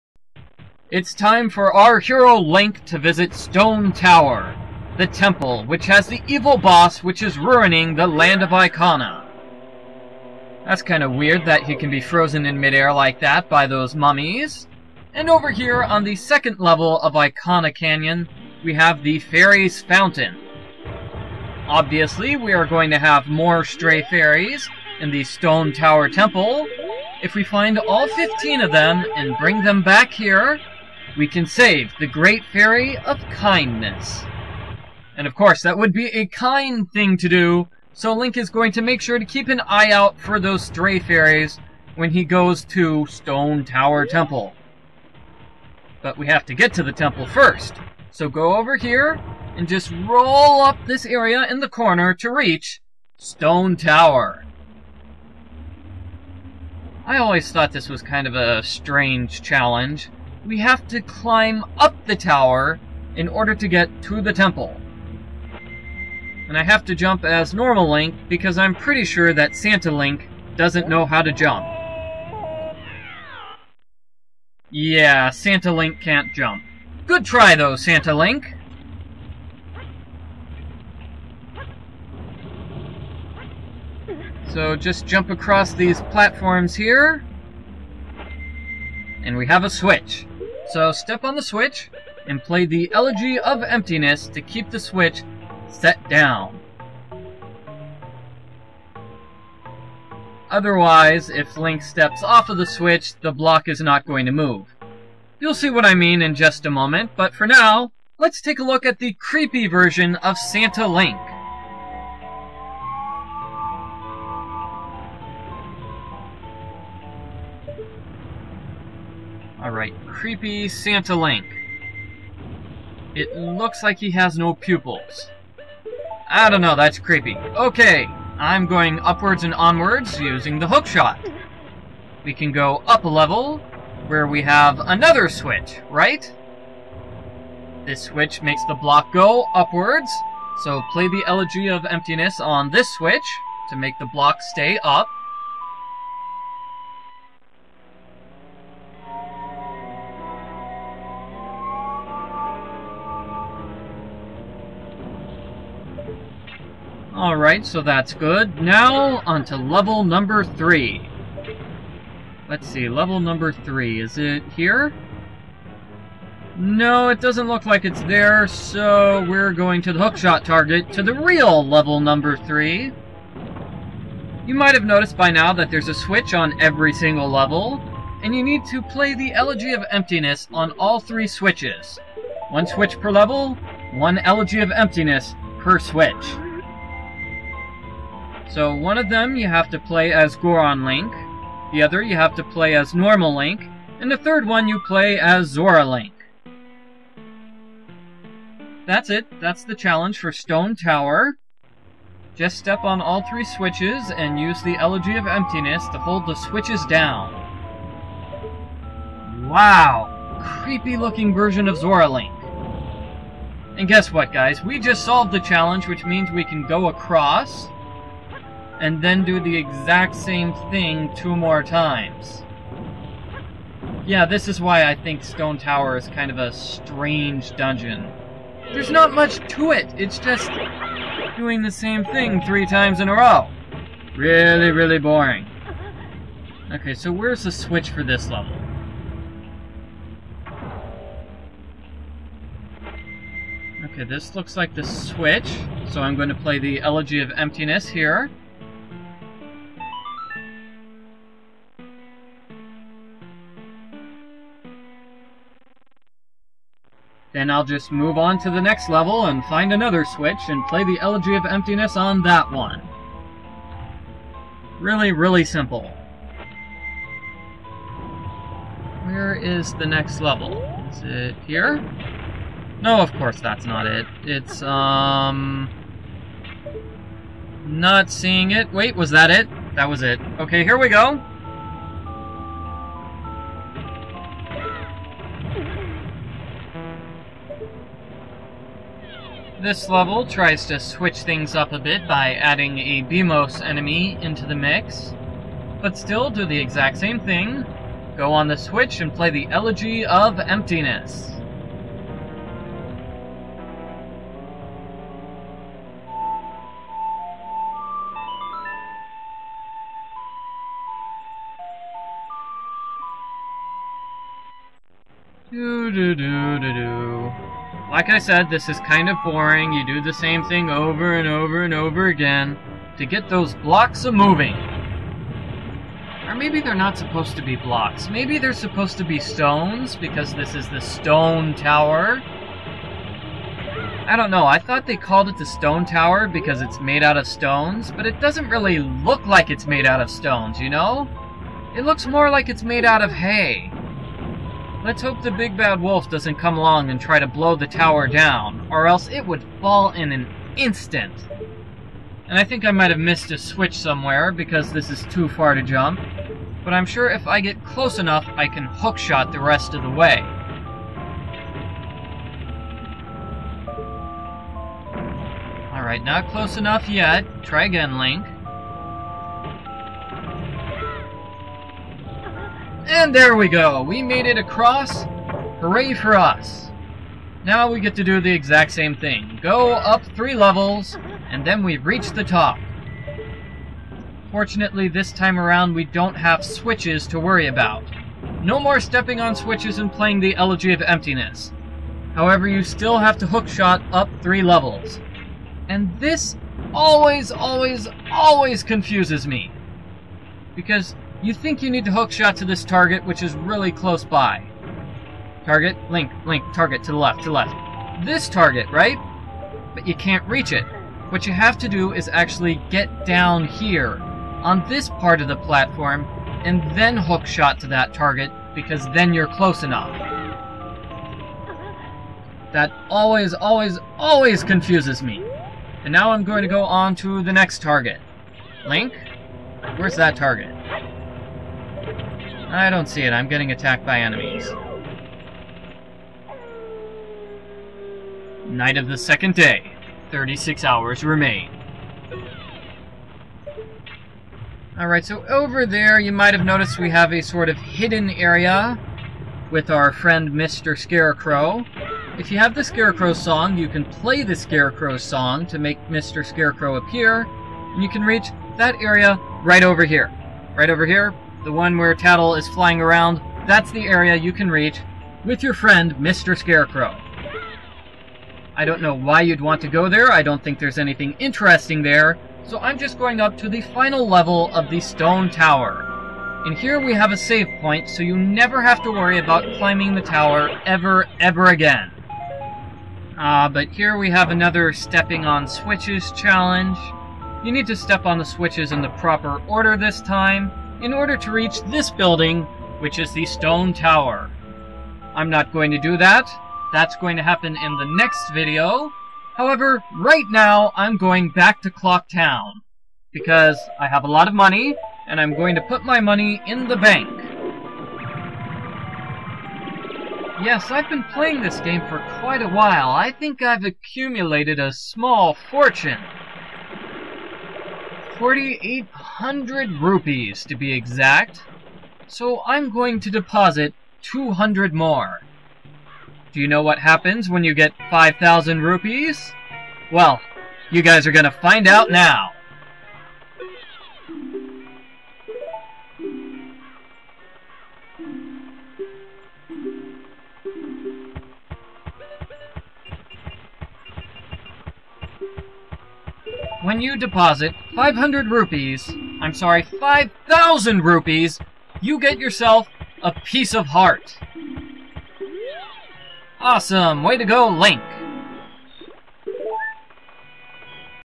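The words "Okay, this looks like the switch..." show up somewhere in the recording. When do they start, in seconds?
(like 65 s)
243 s.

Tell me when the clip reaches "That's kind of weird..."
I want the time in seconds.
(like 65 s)
10 s.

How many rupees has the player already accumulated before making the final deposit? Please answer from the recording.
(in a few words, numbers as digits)
4800.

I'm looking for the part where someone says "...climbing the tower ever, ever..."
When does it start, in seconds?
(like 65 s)
479 s.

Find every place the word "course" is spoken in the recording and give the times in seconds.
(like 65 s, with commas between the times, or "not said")
35 s, 273 s.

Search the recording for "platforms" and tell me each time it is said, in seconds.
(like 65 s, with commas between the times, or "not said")
86 s, 415 s.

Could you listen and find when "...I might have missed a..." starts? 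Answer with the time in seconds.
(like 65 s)
352 s.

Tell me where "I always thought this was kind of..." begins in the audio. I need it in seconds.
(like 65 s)
57 s.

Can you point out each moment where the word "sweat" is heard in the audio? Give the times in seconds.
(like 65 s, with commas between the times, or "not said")
not said.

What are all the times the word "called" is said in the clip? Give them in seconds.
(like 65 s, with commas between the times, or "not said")
334 s.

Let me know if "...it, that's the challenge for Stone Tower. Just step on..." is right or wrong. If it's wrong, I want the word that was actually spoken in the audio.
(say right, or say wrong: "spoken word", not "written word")
right.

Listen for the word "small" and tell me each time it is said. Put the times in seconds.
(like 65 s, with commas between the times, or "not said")
514 s.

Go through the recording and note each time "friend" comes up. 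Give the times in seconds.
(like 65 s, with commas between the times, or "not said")
449 s, 465 s.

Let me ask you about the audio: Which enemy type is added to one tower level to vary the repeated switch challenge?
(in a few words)
Beamos.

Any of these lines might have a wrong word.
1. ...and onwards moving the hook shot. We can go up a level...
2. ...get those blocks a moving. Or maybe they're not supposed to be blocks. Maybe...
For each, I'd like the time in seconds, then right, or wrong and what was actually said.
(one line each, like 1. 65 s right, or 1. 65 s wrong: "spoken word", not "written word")
1. 129 s wrong: "using", not "moving"
2. 323 s right.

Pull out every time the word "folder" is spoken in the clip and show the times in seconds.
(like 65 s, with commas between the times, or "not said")
not said.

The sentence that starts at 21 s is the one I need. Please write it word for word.
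Obviously, we are going to have more stray fairies in the Stone Tower Temple.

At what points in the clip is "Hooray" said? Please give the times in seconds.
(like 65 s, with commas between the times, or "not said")
375 s.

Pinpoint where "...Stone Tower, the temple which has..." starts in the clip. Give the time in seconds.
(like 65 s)
3 s.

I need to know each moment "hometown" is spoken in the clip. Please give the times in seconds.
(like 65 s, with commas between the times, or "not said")
not said.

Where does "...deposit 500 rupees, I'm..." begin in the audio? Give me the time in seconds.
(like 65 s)
546 s.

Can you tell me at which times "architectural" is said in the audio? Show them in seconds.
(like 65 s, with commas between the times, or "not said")
not said.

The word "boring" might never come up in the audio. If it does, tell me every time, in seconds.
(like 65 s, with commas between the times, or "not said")
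234 s, 319 s.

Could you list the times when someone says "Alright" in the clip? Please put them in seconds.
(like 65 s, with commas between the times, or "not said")
157 s, 365 s, 444 s.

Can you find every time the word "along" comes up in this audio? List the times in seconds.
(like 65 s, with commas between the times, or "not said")
346 s.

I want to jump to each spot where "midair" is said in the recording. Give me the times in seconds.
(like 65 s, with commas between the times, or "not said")
12 s.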